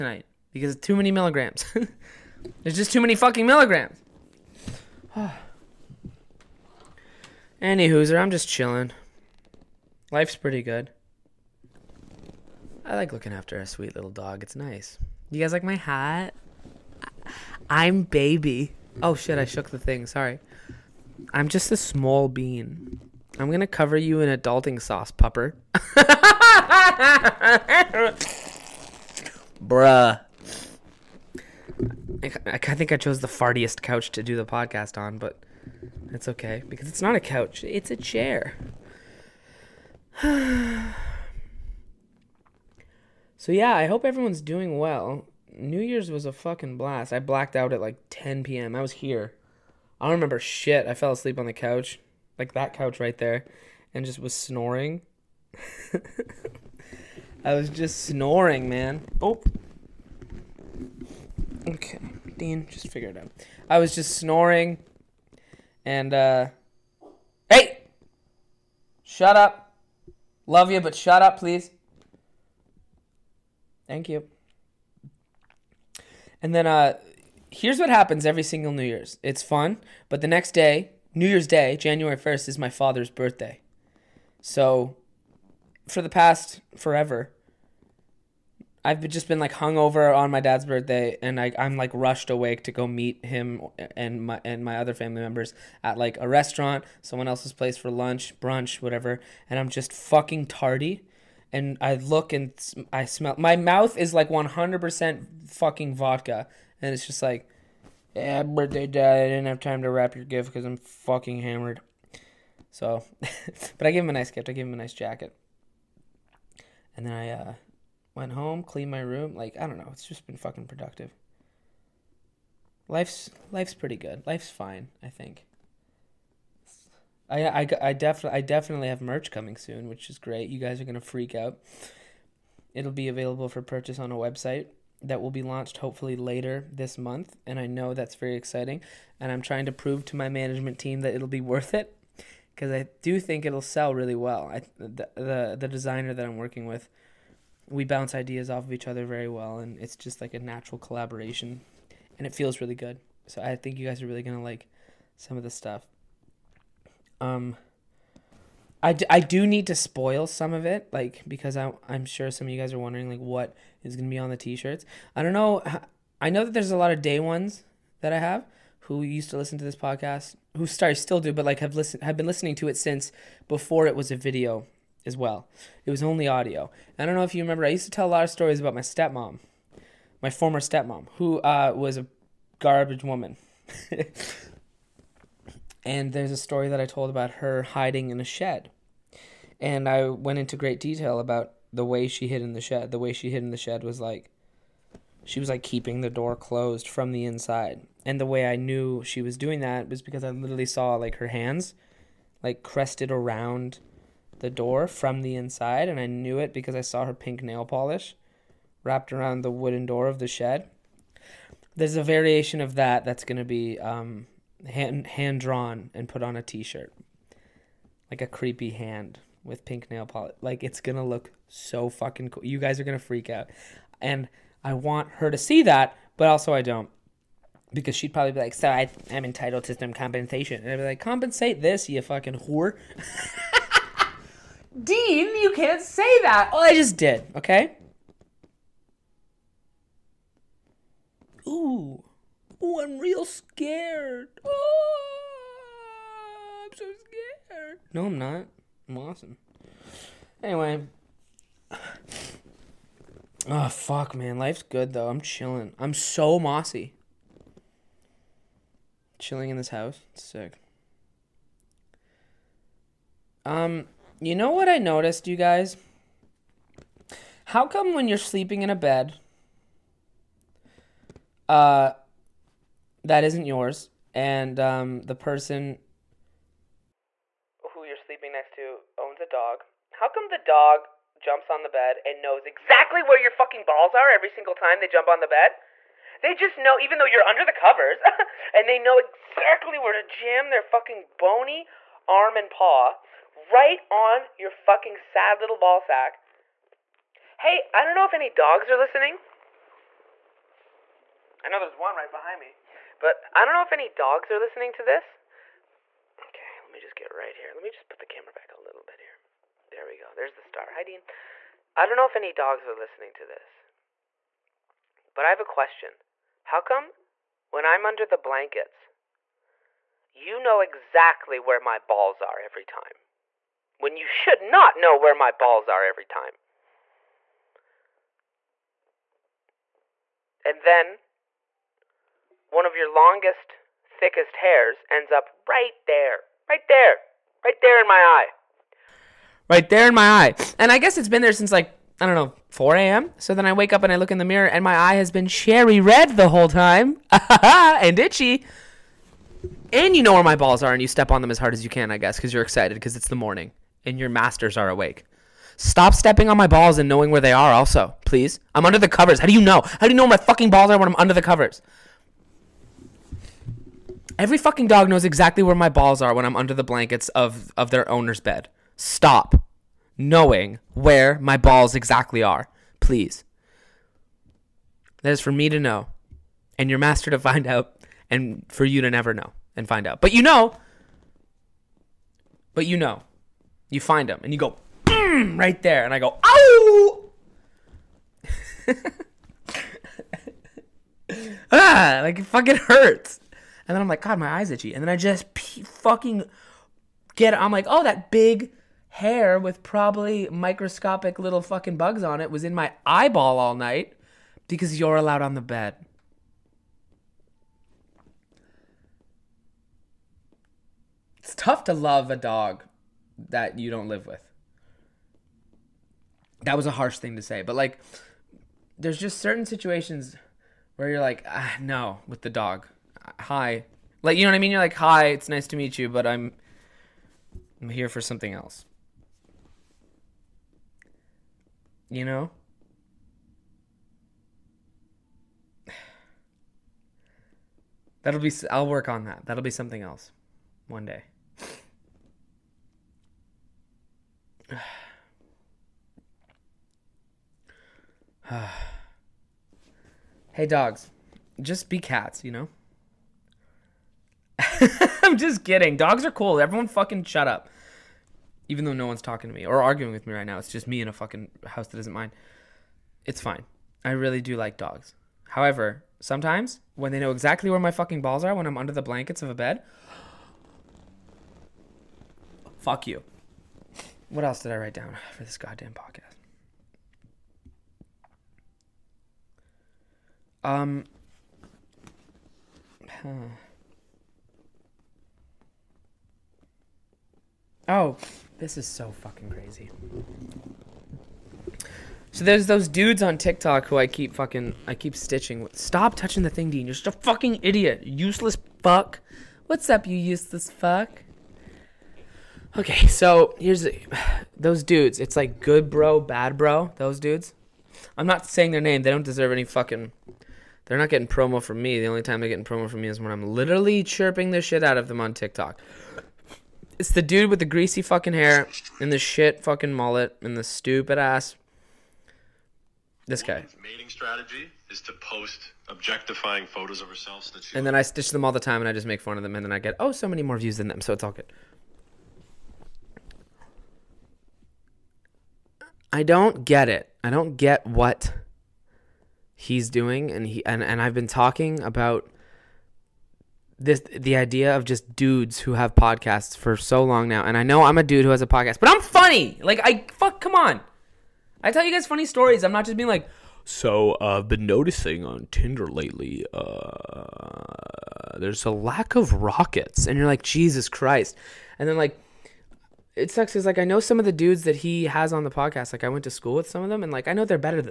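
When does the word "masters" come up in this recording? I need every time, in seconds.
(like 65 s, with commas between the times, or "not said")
354 s, 376 s.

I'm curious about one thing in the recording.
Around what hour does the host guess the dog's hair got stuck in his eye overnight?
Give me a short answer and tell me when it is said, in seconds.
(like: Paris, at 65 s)
4 a.m., at 342 s.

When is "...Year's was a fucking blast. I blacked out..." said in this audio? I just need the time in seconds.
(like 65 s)
45 s.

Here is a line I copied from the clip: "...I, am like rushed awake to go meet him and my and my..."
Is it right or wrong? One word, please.
right.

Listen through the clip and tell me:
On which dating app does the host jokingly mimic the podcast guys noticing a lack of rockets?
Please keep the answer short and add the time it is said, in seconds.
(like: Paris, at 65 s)
Tinder, at 555 s.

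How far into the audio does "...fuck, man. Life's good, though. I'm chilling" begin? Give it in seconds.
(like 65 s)
253 s.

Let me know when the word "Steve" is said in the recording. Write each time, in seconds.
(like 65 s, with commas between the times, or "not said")
not said.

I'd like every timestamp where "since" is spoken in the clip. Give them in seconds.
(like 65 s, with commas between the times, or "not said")
172 s, 341 s.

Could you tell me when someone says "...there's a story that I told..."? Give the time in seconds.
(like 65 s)
186 s.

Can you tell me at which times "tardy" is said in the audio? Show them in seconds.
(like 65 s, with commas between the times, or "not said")
100 s.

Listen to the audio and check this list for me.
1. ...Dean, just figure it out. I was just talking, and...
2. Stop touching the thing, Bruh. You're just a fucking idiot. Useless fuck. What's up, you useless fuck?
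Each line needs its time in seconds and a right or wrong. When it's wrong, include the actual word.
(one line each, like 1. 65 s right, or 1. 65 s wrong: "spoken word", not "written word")
1. 62 s wrong: "snoring", not "talking"
2. 495 s wrong: "Dean", not "Bruh".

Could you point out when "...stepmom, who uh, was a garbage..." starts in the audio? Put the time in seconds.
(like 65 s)
180 s.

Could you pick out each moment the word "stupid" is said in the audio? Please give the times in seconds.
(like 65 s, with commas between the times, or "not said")
520 s.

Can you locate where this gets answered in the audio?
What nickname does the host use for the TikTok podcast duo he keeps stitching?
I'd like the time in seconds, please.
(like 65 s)
505 s.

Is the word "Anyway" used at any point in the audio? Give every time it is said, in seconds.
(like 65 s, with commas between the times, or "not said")
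250 s.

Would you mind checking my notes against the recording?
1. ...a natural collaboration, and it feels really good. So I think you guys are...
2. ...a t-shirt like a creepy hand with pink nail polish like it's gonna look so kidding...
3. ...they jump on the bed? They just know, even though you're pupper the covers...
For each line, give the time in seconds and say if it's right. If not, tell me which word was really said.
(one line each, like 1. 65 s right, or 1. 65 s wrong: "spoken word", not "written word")
1. 150 s right
2. 216 s wrong: "fucking", not "kidding"
3. 284 s wrong: "under", not "pupper".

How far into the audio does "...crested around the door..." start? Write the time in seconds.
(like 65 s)
202 s.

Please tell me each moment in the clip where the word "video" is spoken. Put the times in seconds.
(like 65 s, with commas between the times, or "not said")
174 s.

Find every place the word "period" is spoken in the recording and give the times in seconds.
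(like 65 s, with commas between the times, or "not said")
not said.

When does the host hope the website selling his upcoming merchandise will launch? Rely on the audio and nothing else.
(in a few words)
Later this month.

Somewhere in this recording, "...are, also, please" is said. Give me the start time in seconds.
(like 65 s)
357 s.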